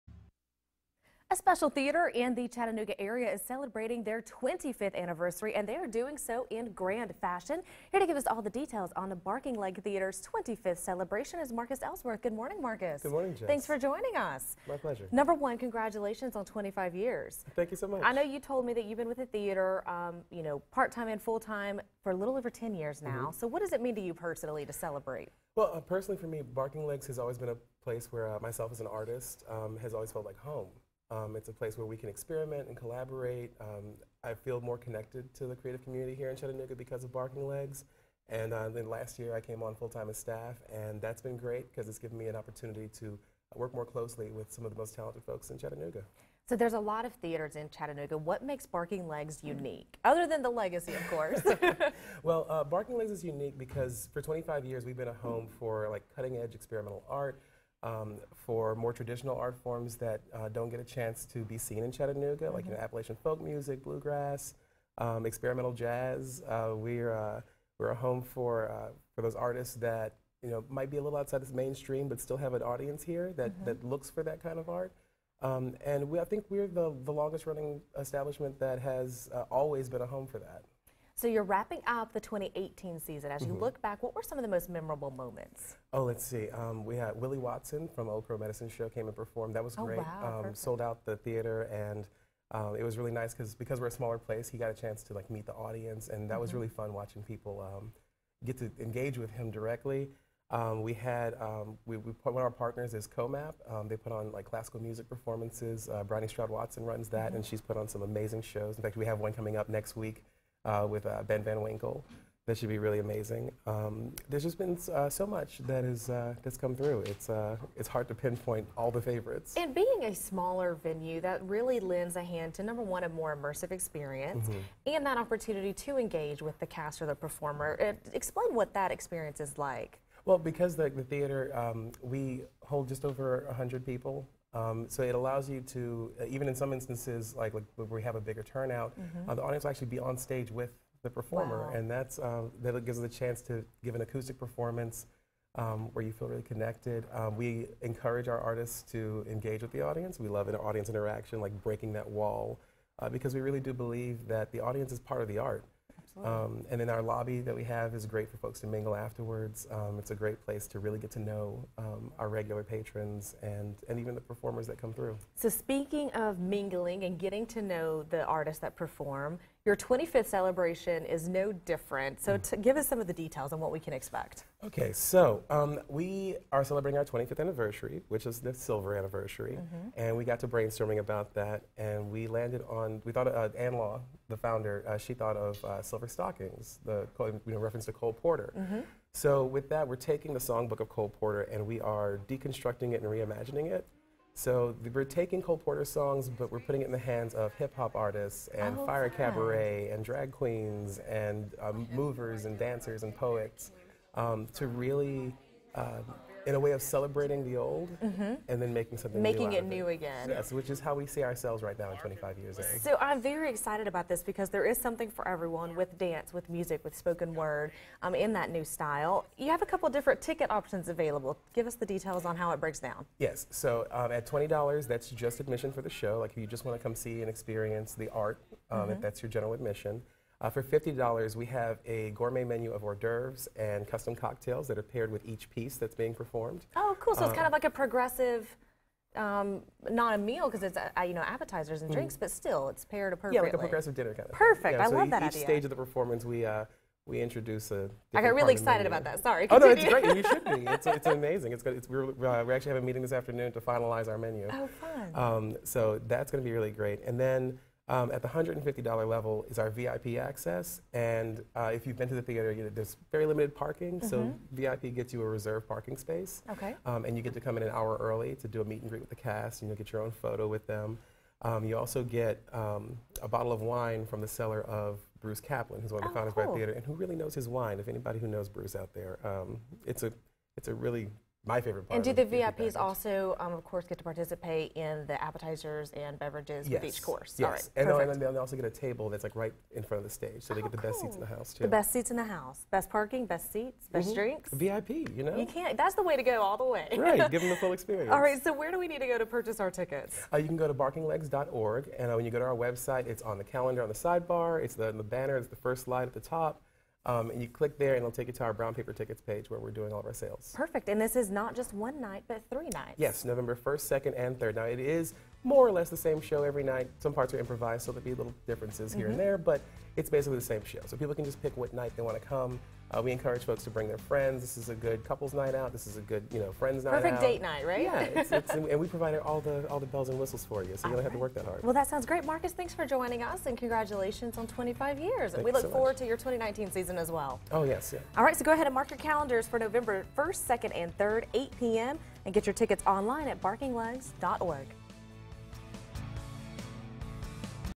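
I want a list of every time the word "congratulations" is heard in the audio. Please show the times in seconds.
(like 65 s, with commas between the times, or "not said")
15 s, 333 s.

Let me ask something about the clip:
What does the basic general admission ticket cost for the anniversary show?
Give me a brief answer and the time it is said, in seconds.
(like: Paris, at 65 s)
$20, at 224 s.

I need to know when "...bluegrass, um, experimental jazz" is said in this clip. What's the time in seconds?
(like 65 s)
63 s.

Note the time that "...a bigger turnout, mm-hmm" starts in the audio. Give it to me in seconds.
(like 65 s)
138 s.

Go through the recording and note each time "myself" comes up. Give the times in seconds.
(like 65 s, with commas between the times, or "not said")
28 s.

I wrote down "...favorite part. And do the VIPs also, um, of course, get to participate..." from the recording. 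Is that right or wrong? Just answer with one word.
right.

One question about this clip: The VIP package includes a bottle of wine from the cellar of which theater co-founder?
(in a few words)
Bruce Kaplan.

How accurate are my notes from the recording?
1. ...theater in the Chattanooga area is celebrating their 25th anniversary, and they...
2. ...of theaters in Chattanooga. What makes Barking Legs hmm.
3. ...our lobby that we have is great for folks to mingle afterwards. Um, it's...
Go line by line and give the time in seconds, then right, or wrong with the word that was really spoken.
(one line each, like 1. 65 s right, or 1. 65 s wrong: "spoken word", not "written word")
1. 1 s right
2. 47 s right
3. 156 s right.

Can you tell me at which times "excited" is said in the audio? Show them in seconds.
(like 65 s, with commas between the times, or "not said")
213 s, 248 s.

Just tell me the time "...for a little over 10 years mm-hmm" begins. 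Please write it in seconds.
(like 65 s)
22 s.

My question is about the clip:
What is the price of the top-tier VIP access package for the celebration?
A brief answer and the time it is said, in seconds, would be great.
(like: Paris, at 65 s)
$150, at 258 s.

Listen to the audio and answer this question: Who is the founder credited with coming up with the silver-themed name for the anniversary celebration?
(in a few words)
Ann Law.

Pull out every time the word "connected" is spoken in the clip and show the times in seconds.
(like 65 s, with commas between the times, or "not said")
34 s, 146 s.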